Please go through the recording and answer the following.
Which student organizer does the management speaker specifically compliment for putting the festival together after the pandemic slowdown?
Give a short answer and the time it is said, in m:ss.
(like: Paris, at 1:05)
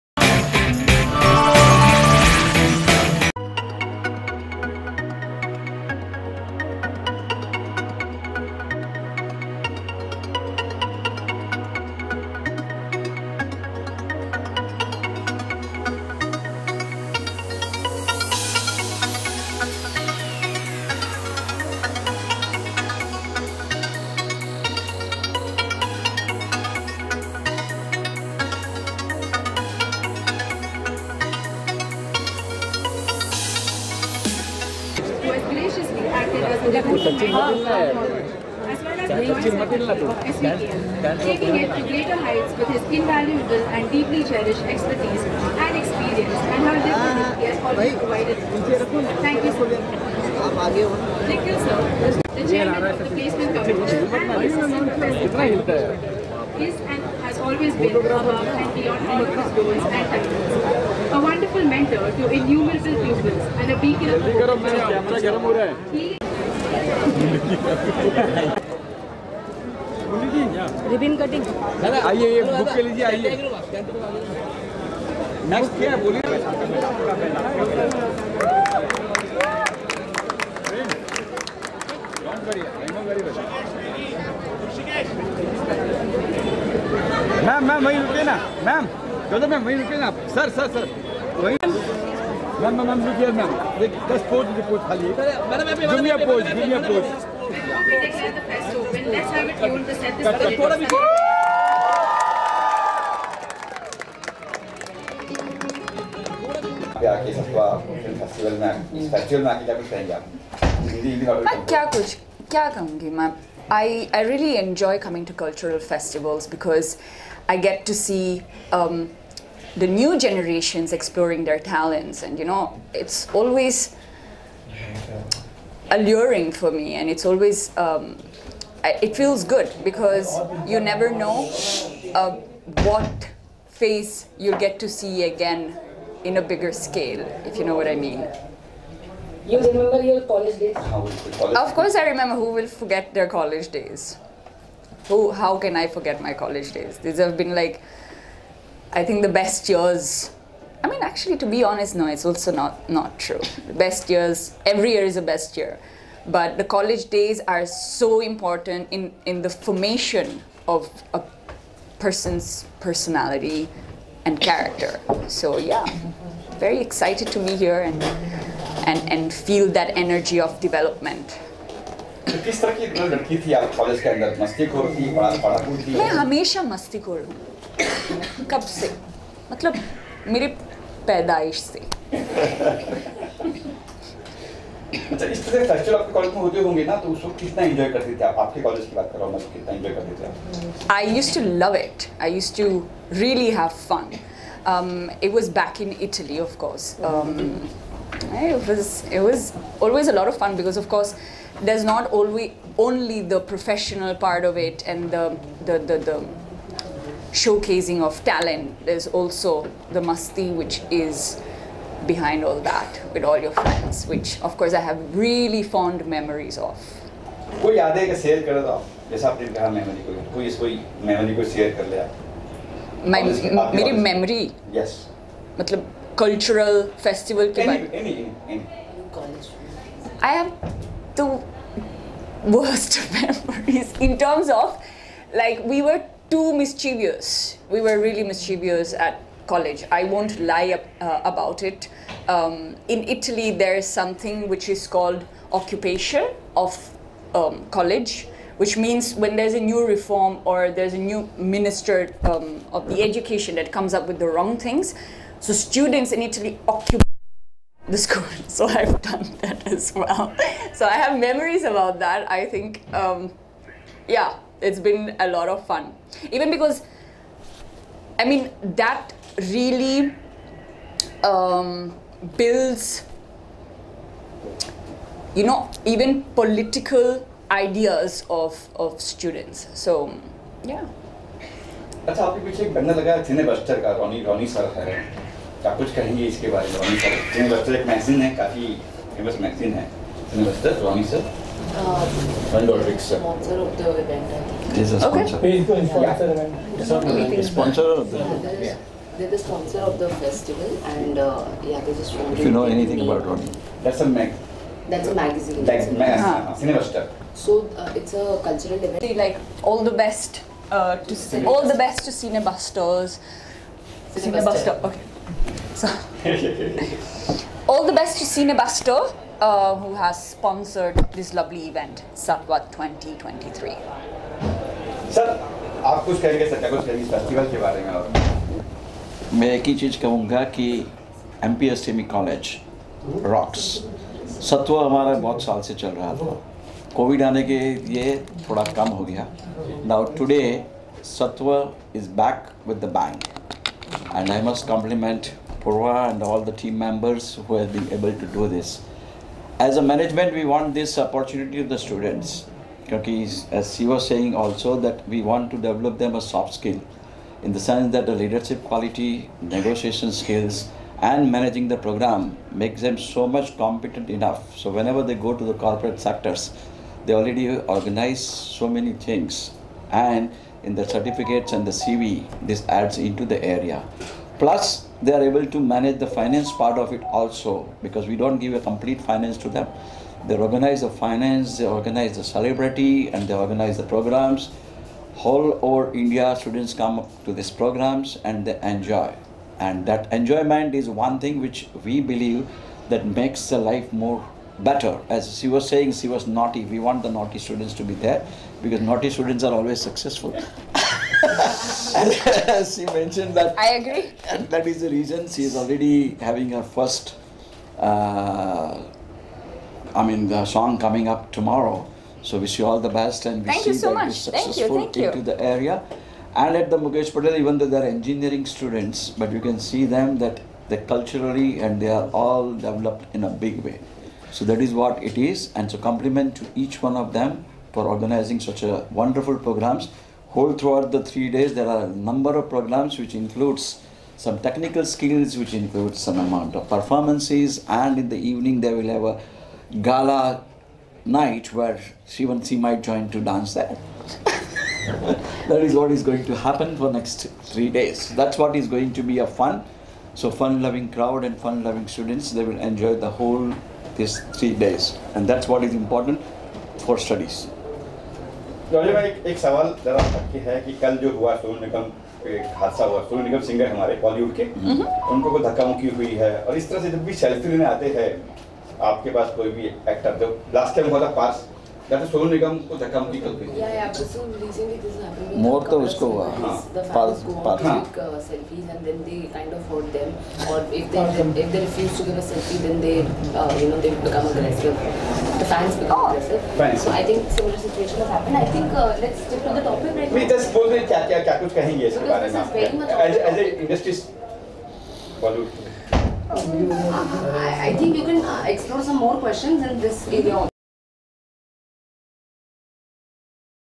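Purva, at 5:45.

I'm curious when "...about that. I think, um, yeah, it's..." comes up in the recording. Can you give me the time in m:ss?
4:21.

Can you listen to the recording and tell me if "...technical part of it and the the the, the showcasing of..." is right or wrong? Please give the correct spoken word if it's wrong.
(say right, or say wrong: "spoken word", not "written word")
wrong: "professional", not "technical".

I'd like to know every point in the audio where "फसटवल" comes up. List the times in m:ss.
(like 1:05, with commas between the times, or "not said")
1:36, 1:49, 3:05, 3:47.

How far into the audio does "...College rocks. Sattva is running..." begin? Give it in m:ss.
5:32.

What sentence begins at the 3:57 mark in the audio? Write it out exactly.
We were really mischievous at college.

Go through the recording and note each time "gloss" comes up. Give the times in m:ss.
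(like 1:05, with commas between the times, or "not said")
not said.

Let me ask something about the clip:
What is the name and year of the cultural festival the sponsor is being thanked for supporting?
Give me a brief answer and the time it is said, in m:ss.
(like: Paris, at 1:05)
Sattva 2023, at 5:22.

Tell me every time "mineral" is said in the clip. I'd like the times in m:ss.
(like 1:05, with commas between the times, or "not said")
not said.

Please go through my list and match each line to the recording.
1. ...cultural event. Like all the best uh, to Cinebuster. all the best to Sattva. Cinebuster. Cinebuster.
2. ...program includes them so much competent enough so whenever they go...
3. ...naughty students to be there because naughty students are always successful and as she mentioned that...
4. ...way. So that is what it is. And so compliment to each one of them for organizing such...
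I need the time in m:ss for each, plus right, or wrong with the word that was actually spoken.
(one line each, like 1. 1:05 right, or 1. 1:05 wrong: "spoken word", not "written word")
1. 5:08 wrong: "Cinebusters", not "Sattva"
2. 6:01 wrong: "makes", not "includes"
3. 6:37 right
4. 7:03 right.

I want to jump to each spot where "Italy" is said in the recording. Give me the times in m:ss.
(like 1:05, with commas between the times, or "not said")
3:16, 4:03, 4:16.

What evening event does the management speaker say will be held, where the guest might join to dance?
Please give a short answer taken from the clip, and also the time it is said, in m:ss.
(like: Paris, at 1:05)
Gala night, at 7:19.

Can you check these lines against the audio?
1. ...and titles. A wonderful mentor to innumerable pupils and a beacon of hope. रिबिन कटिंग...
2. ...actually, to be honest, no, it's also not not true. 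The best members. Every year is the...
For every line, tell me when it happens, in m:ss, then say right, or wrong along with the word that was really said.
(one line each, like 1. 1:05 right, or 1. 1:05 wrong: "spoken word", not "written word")
1. 0:59 right
2. 2:31 wrong: "years", not "members".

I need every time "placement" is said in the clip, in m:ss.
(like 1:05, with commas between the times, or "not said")
0:53.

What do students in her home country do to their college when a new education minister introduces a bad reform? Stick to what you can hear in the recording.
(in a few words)
Occupation.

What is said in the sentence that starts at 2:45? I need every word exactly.
So yeah, very excited to be here and and and feel that energy of development.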